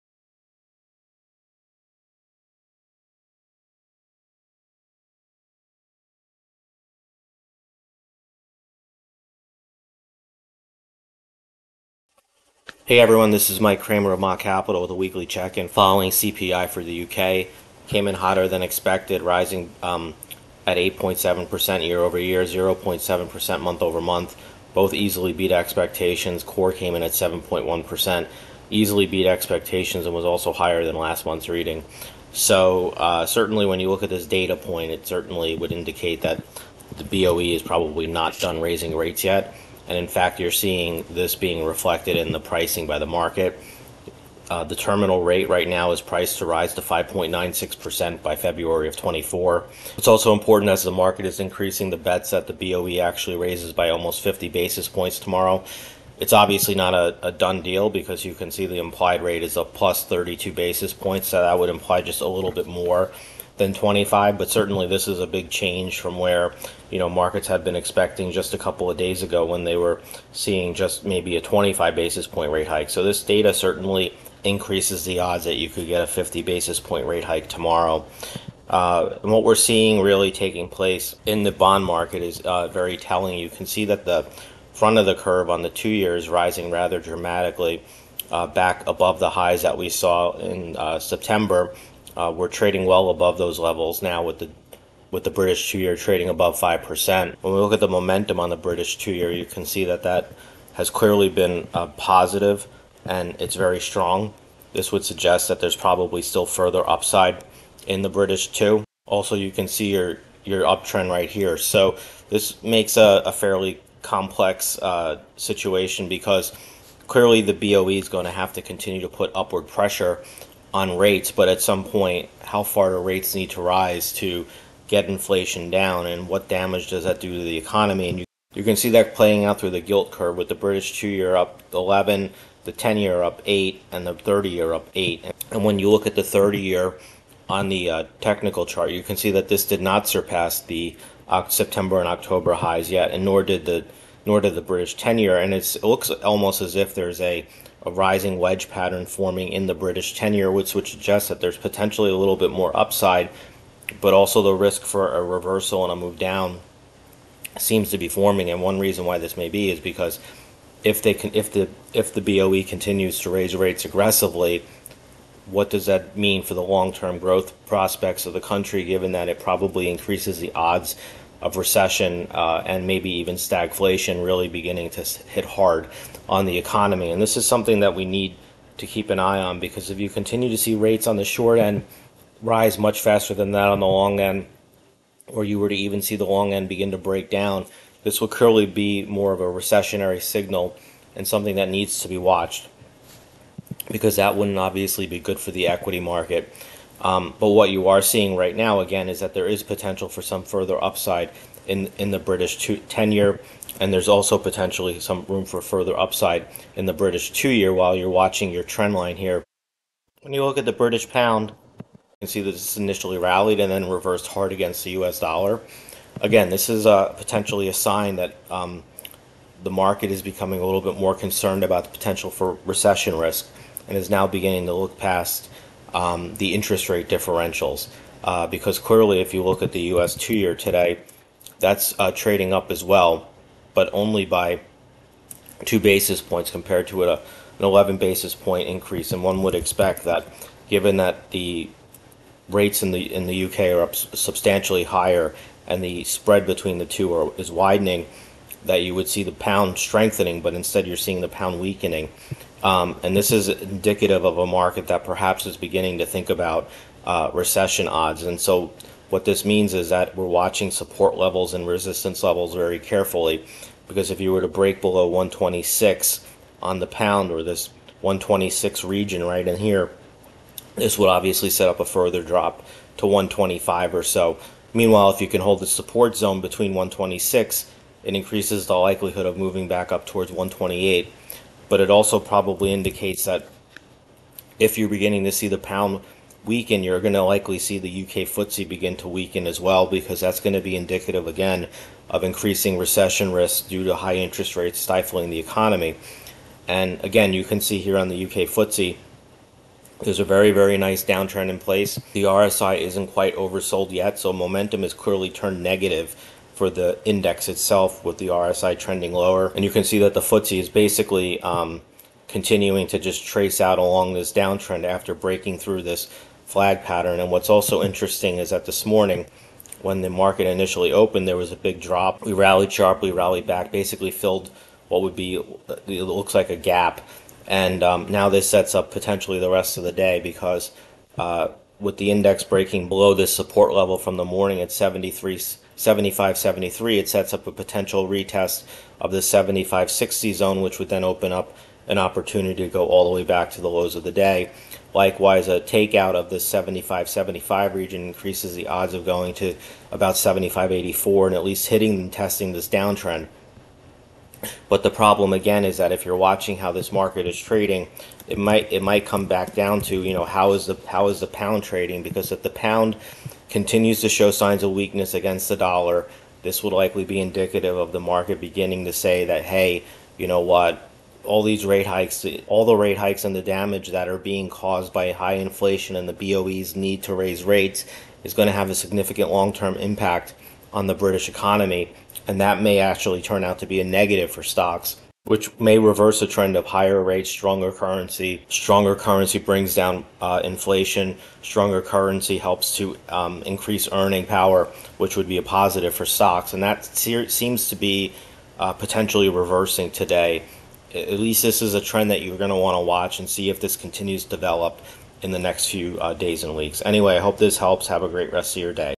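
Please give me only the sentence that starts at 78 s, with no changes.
Uh, and what we're seeing really taking place in the bond market is uh, very telling.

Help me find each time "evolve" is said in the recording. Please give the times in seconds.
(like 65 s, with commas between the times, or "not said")
not said.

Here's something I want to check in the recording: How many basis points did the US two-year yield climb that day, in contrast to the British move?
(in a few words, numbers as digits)
2.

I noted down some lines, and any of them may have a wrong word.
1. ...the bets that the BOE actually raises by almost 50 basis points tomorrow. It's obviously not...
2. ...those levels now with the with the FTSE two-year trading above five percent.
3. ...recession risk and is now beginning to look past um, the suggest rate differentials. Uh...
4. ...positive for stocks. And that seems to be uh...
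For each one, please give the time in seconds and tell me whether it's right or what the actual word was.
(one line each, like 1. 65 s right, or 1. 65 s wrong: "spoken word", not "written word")
1. 51 s right
2. 93 s wrong: "British", not "FTSE"
3. 222 s wrong: "interest", not "suggest"
4. 395 s right.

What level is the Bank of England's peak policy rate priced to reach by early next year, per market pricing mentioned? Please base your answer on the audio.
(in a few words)
5.96%.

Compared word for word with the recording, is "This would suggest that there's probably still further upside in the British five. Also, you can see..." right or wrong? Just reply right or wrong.
wrong.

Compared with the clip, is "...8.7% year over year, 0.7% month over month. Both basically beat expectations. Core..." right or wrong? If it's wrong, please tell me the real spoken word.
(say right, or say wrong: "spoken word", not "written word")
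wrong: "easily", not "basically".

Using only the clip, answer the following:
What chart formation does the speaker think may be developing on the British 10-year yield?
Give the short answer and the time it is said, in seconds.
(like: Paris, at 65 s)
rising wedge, at 147 s.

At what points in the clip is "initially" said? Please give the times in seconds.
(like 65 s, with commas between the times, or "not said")
212 s, 320 s.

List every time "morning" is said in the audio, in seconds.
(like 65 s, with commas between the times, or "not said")
318 s, 334 s.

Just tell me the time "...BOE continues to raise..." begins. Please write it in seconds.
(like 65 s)
162 s.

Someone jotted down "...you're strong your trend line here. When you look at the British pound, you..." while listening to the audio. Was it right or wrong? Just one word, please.
wrong.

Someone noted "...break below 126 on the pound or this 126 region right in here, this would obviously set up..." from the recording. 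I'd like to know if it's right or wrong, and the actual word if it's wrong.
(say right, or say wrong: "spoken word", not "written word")
right.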